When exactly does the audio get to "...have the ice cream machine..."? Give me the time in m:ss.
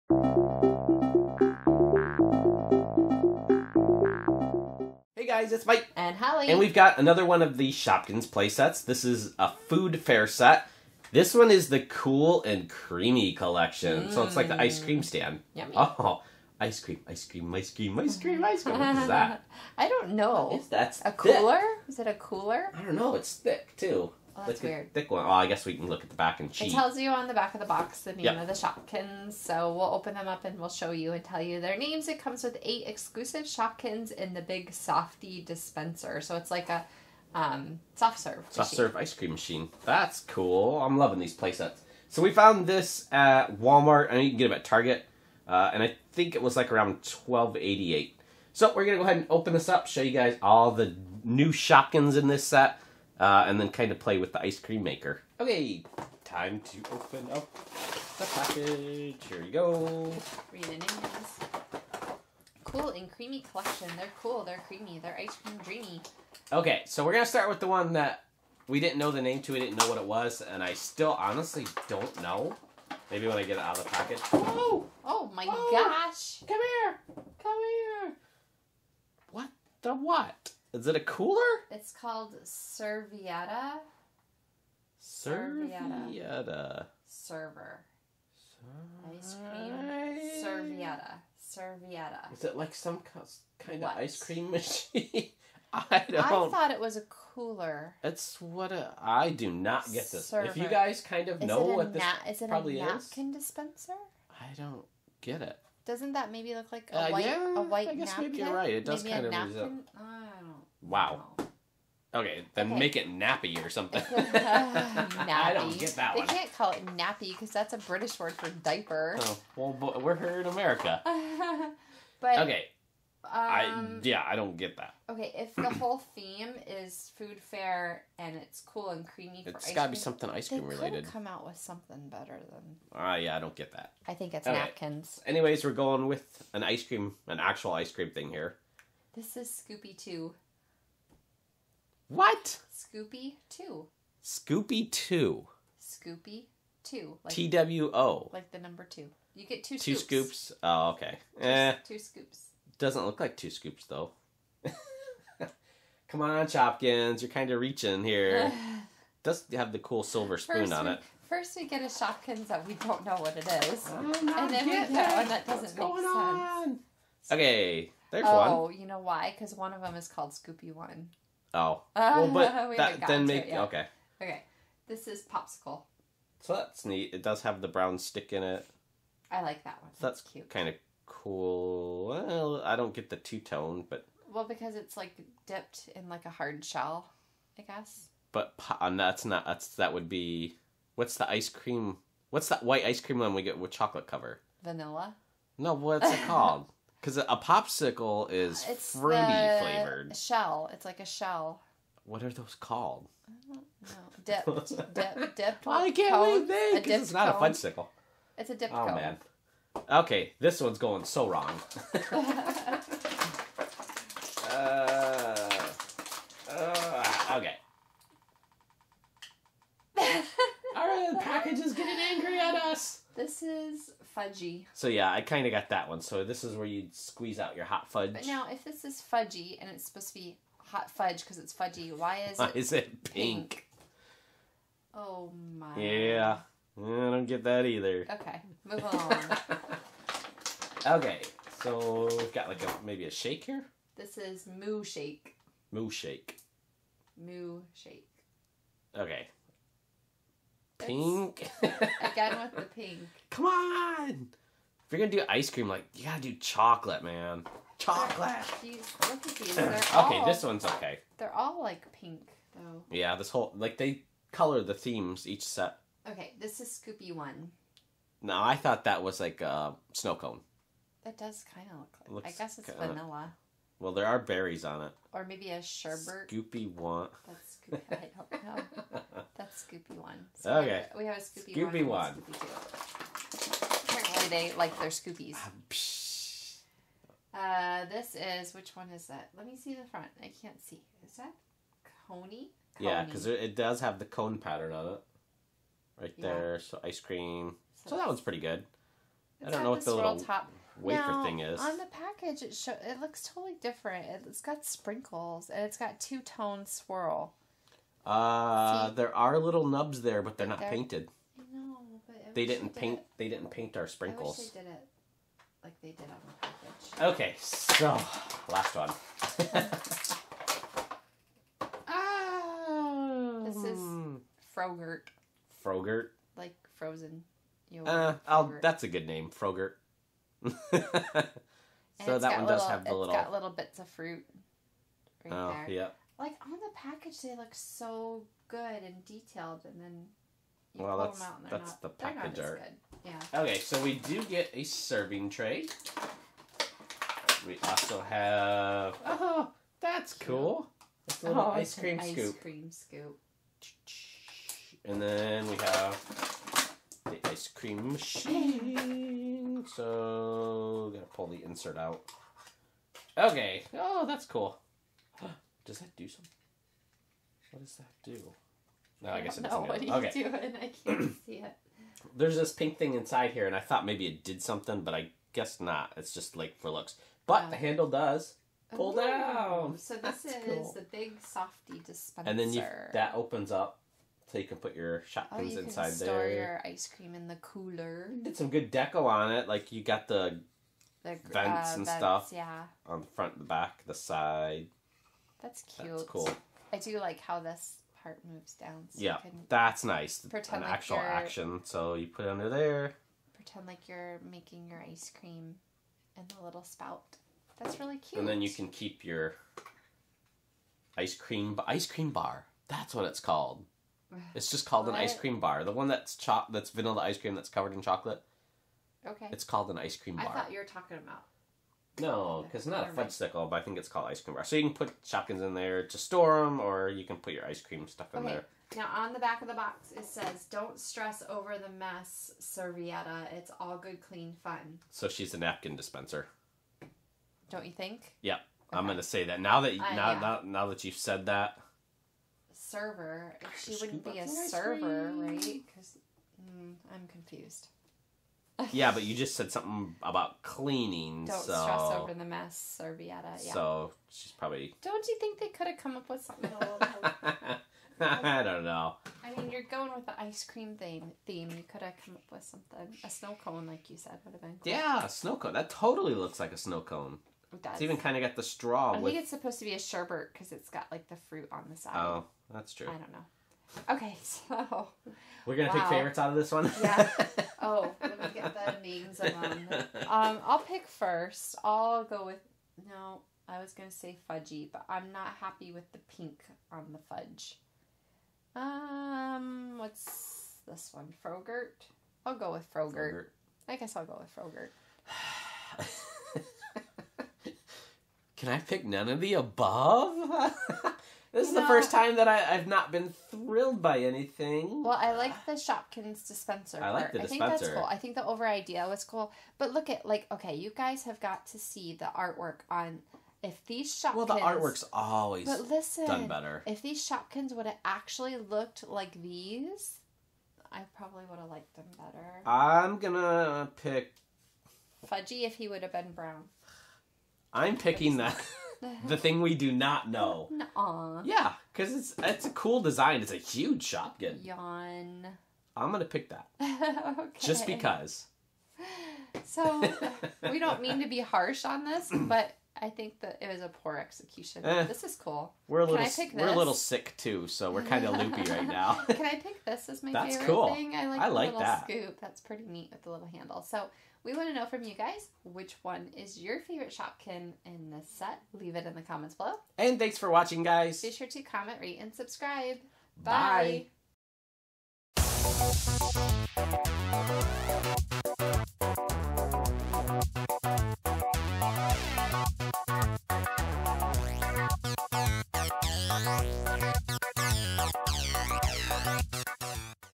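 5:55.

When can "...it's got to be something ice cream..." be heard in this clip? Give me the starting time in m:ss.
2:09.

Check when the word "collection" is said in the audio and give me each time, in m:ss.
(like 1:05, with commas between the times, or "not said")
0:13, 1:03.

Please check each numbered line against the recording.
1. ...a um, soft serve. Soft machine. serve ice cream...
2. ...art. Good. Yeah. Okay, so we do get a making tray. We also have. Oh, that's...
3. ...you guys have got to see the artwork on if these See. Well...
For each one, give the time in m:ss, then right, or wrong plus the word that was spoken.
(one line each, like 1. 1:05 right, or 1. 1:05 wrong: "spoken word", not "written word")
1. 0:36 right
2. 5:42 wrong: "serving", not "making"
3. 8:30 wrong: "Shopkins", not "See".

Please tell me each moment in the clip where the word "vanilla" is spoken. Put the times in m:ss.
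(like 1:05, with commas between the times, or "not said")
3:14, 4:32, 6:56.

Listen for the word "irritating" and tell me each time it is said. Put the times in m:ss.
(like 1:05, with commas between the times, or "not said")
not said.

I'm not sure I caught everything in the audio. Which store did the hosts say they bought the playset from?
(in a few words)
Walmart.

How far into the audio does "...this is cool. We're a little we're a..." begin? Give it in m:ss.
9:04.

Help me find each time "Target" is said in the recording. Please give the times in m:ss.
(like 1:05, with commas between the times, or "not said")
0:44.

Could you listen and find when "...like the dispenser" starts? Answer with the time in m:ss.
8:26.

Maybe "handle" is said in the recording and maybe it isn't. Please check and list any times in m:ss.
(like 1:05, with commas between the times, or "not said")
6:17, 9:13.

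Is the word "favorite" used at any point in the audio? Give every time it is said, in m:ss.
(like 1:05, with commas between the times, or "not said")
7:55, 9:10, 9:16.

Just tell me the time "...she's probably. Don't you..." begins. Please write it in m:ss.
7:34.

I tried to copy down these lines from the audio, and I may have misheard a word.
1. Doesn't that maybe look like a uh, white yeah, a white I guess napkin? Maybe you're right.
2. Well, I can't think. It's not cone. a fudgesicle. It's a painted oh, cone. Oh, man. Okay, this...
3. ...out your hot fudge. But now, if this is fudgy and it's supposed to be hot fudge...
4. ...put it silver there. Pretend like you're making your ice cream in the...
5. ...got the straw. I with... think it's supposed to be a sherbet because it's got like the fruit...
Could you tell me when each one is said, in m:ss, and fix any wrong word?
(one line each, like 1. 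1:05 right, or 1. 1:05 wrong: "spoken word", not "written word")
1. 1:45 right
2. 3:25 wrong: "dipped", not "painted"
3. 3:47 right
4. 6:42 wrong: "under", not "silver"
5. 7:48 right.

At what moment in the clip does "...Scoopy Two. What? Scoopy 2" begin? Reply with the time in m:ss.
2:19.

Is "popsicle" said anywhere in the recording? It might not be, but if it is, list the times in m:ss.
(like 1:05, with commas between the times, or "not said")
2:55, 3:17.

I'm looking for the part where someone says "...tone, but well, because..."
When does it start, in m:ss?
3:03.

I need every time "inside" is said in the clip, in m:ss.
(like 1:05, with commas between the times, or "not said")
6:12, 6:25.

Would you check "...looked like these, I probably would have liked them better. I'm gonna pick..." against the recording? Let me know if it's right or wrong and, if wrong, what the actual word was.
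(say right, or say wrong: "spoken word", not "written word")
right.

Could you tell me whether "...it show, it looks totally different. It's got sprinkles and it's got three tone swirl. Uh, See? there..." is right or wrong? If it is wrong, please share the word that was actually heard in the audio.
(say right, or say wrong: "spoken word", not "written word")
wrong: "two", not "three".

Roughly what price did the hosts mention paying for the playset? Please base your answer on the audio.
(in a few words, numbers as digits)
$12.88.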